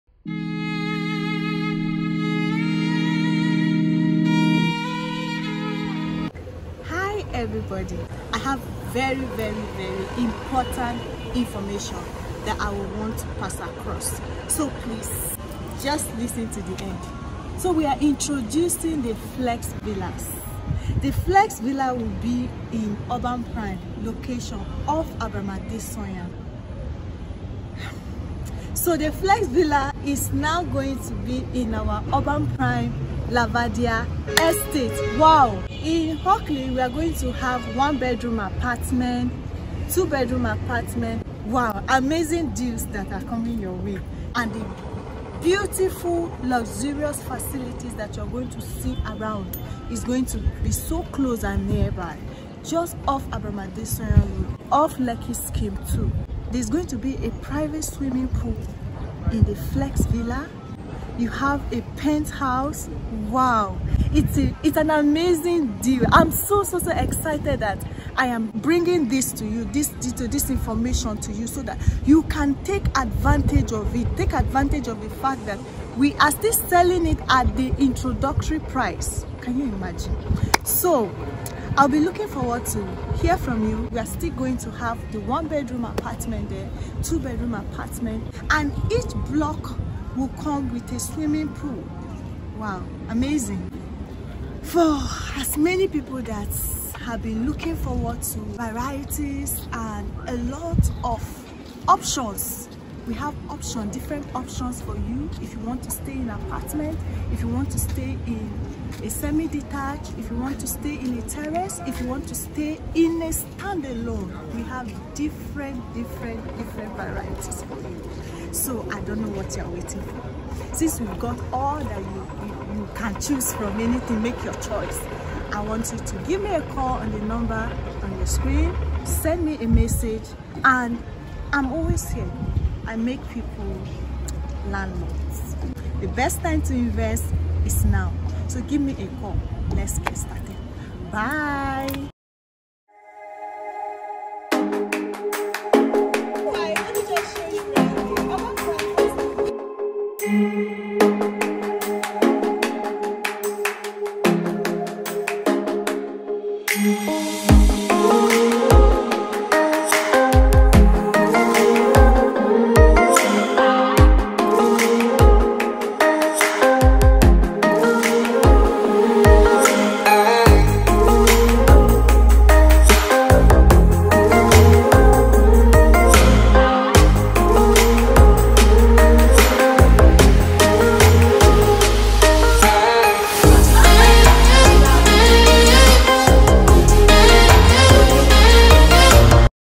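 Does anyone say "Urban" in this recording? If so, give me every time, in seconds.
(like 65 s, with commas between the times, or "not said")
23 s, 32 s.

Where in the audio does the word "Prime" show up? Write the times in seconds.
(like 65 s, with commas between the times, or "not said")
23 s, 32 s.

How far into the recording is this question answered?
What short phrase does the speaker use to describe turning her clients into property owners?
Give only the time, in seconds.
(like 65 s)
132 s.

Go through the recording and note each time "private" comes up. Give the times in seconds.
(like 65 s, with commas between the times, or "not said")
57 s.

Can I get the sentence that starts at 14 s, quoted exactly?
So please, just listen to the end.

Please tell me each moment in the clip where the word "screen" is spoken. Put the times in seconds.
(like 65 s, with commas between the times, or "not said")
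128 s.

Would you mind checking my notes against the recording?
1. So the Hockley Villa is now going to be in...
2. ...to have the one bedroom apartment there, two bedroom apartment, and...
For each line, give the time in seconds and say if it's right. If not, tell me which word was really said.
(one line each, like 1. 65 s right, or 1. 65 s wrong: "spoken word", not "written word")
1. 28 s wrong: "Flex", not "Hockley"
2. 84 s right.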